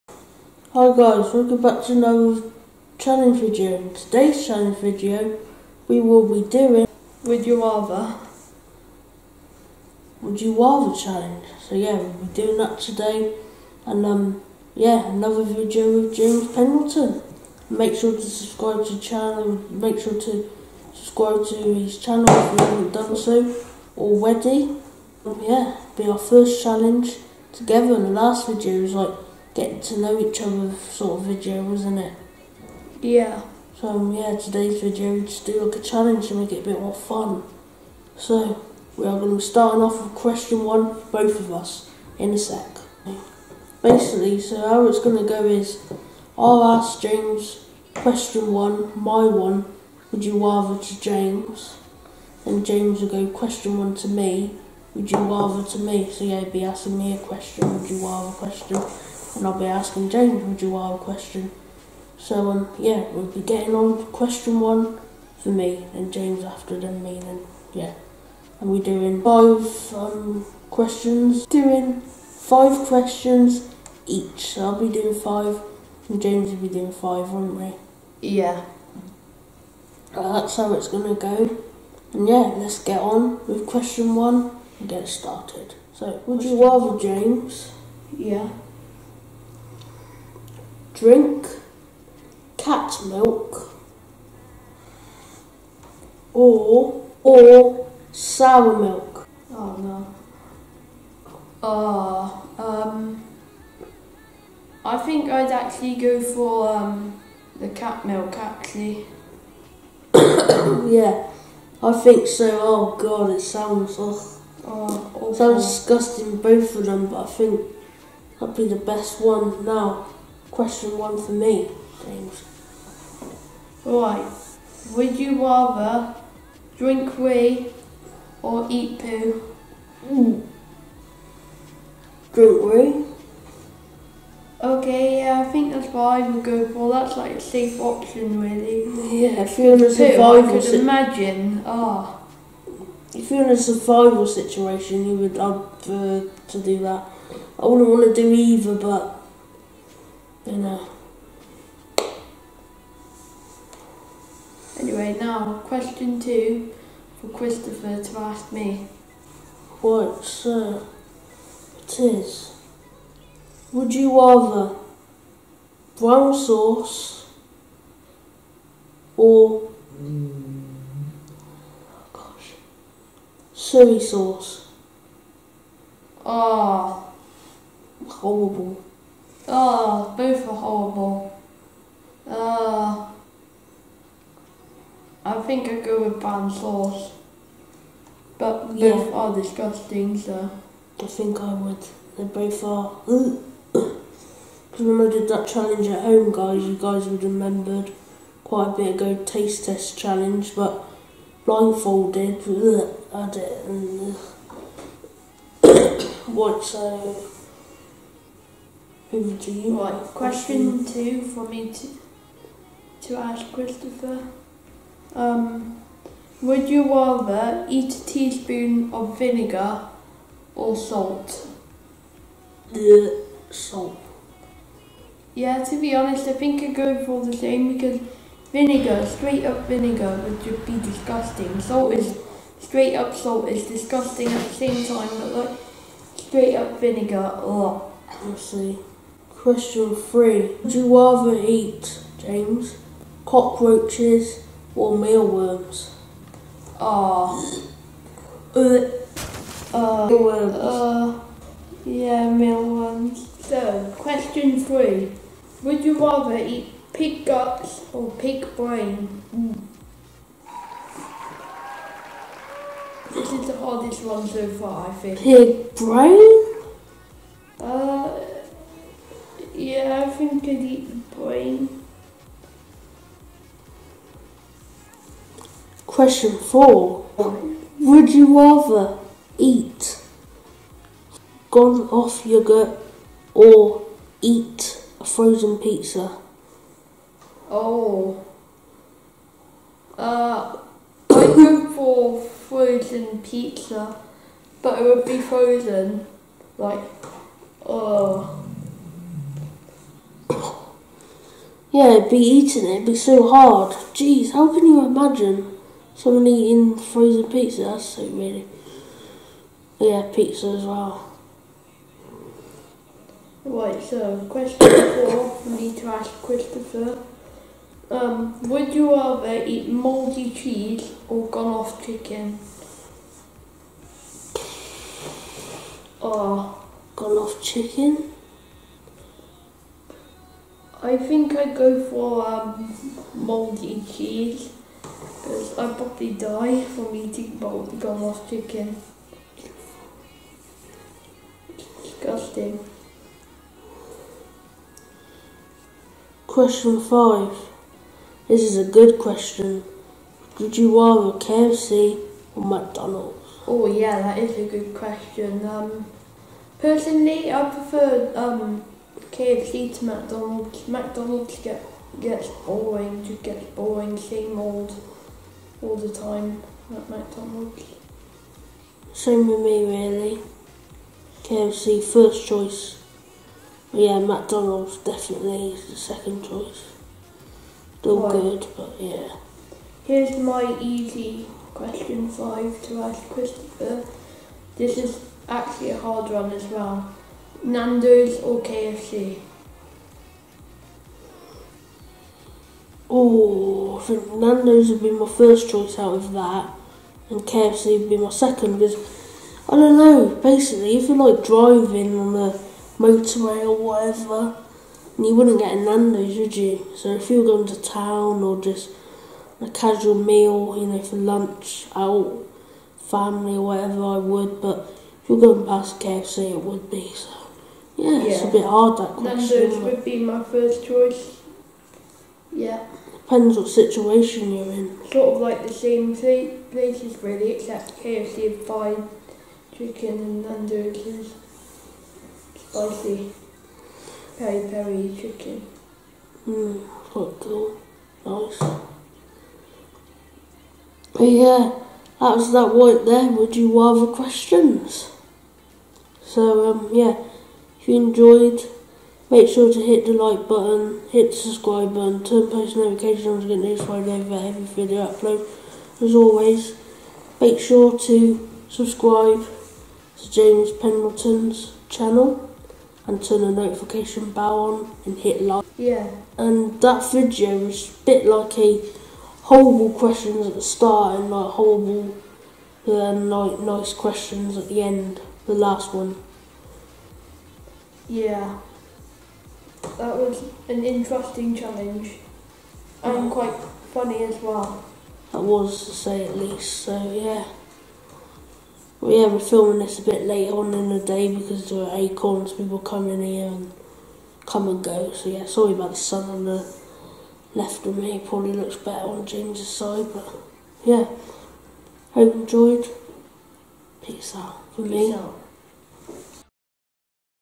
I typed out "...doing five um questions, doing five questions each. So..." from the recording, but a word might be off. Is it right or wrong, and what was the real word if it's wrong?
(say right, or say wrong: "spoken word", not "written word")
right.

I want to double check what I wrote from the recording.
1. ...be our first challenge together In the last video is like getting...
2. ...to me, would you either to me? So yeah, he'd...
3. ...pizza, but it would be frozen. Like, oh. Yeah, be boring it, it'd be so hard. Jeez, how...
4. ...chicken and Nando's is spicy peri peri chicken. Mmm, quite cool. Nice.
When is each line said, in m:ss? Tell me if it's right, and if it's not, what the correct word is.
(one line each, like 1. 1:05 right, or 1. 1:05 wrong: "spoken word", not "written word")
1. 0:25 right
2. 0:53 wrong: "rather", not "either"
3. 4:53 wrong: "eating", not "boring"
4. 7:09 right.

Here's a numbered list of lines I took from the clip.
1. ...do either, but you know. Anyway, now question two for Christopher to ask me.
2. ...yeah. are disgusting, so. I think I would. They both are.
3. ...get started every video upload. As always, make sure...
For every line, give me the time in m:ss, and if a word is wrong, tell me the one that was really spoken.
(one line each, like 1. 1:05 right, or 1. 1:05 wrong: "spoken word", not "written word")
1. 2:28 right
2. 3:08 right
3. 7:33 wrong: "notified", not "started".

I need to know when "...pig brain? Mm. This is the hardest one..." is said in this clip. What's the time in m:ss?
4:18.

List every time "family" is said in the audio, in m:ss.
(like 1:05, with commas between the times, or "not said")
6:52.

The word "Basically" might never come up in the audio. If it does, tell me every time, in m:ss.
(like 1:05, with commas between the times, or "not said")
0:43, 6:40.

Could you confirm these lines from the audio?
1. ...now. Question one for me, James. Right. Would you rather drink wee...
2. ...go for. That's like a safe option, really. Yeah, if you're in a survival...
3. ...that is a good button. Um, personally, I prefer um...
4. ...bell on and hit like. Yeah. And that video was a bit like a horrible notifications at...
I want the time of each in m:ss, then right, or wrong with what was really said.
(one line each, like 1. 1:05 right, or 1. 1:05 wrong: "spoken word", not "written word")
1. 1:59 right
2. 2:16 right
3. 5:54 wrong: "question", not "button"
4. 7:44 wrong: "questions", not "notifications".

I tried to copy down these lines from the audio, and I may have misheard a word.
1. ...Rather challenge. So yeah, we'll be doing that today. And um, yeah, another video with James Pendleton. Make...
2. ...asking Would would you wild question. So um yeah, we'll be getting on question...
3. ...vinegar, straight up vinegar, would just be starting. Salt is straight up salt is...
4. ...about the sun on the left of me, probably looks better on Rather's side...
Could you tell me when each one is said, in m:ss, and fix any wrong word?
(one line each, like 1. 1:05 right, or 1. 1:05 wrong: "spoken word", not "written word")
1. 0:10 right
2. 0:59 wrong: "James", not "Would"
3. 3:48 wrong: "disgusting", not "starting"
4. 8:15 wrong: "James", not "Rather".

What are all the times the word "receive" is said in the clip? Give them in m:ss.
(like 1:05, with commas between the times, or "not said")
not said.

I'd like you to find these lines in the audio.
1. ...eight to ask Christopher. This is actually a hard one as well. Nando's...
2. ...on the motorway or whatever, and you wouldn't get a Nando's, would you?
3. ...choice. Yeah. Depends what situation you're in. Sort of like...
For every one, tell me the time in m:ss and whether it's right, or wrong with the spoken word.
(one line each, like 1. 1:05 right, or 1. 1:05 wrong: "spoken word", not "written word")
1. 6:22 wrong: "five", not "eight"
2. 6:41 right
3. 7:00 right.